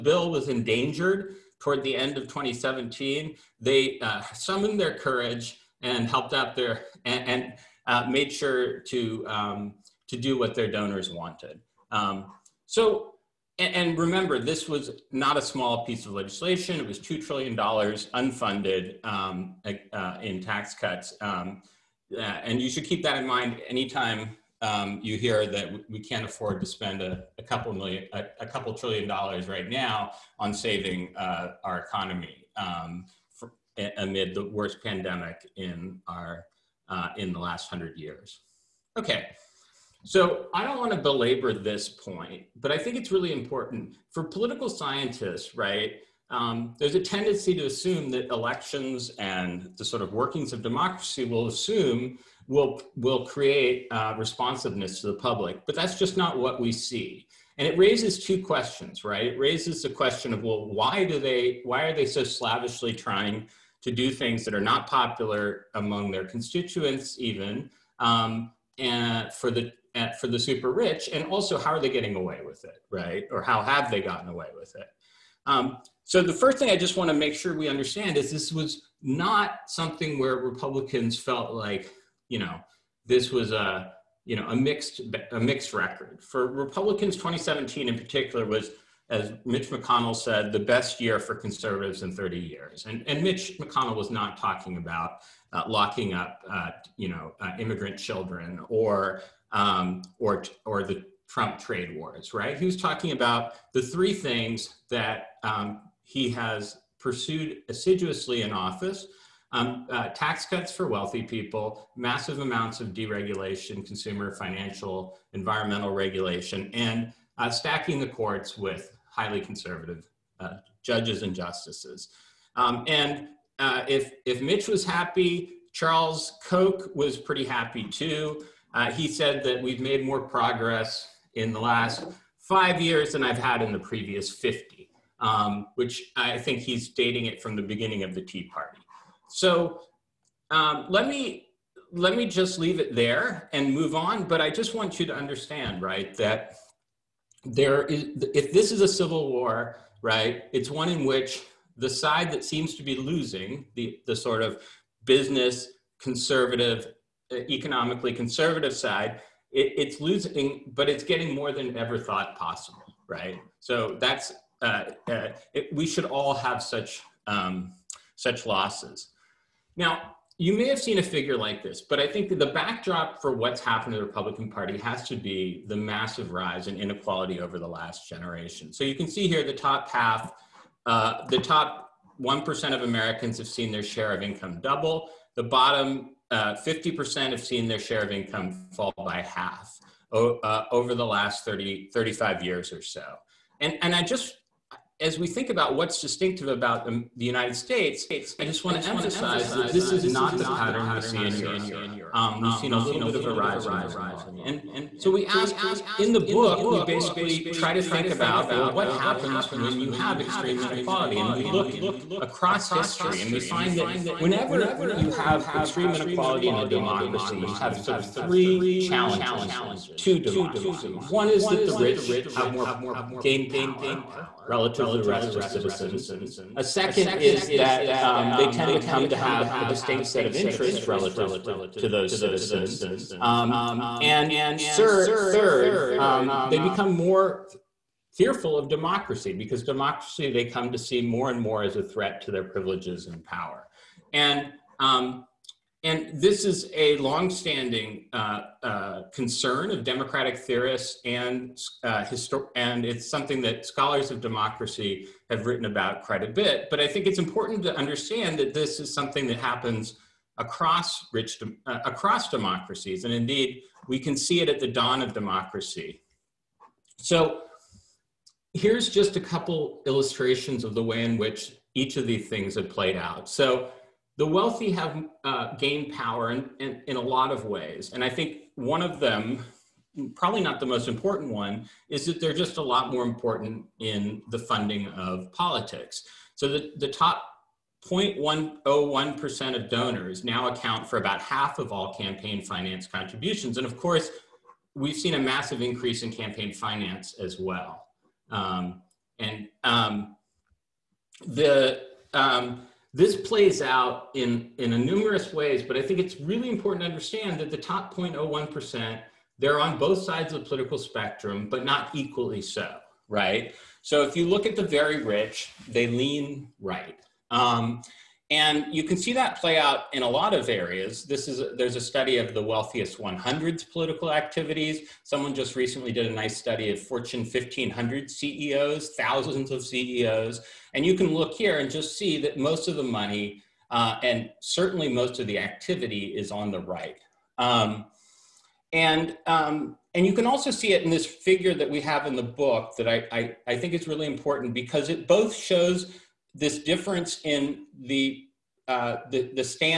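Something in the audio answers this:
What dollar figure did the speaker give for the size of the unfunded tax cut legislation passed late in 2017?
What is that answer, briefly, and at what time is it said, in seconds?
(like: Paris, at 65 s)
$2 trillion, at 16 s.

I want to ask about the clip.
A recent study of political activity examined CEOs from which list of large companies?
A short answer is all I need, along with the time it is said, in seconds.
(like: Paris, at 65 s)
Fortune 1500, at 326 s.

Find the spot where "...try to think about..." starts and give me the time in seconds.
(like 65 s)
207 s.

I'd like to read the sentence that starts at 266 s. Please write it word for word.
So here's just a couple illustrations of the way in which each of these things have played out.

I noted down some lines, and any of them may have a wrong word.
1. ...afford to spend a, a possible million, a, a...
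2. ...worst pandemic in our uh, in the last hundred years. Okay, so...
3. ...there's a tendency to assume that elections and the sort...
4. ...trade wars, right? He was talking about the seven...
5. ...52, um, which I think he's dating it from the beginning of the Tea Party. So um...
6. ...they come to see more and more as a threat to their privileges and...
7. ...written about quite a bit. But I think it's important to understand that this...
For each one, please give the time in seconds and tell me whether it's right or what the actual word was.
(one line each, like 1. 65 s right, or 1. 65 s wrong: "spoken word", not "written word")
1. 26 s wrong: "couple", not "possible"
2. 34 s right
3. 46 s right
4. 101 s wrong: "three", not "seven"
5. 134 s wrong: "50", not "52"
6. 240 s right
7. 255 s right.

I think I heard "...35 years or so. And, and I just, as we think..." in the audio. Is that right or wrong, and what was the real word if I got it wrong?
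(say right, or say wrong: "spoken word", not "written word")
right.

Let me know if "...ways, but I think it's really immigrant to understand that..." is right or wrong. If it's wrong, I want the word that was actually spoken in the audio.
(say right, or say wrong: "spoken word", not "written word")
wrong: "important", not "immigrant".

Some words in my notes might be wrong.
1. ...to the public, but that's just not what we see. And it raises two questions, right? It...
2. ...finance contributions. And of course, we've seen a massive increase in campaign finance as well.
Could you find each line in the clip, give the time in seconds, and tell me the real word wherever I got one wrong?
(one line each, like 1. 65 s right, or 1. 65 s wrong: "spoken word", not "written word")
1. 55 s right
2. 292 s right.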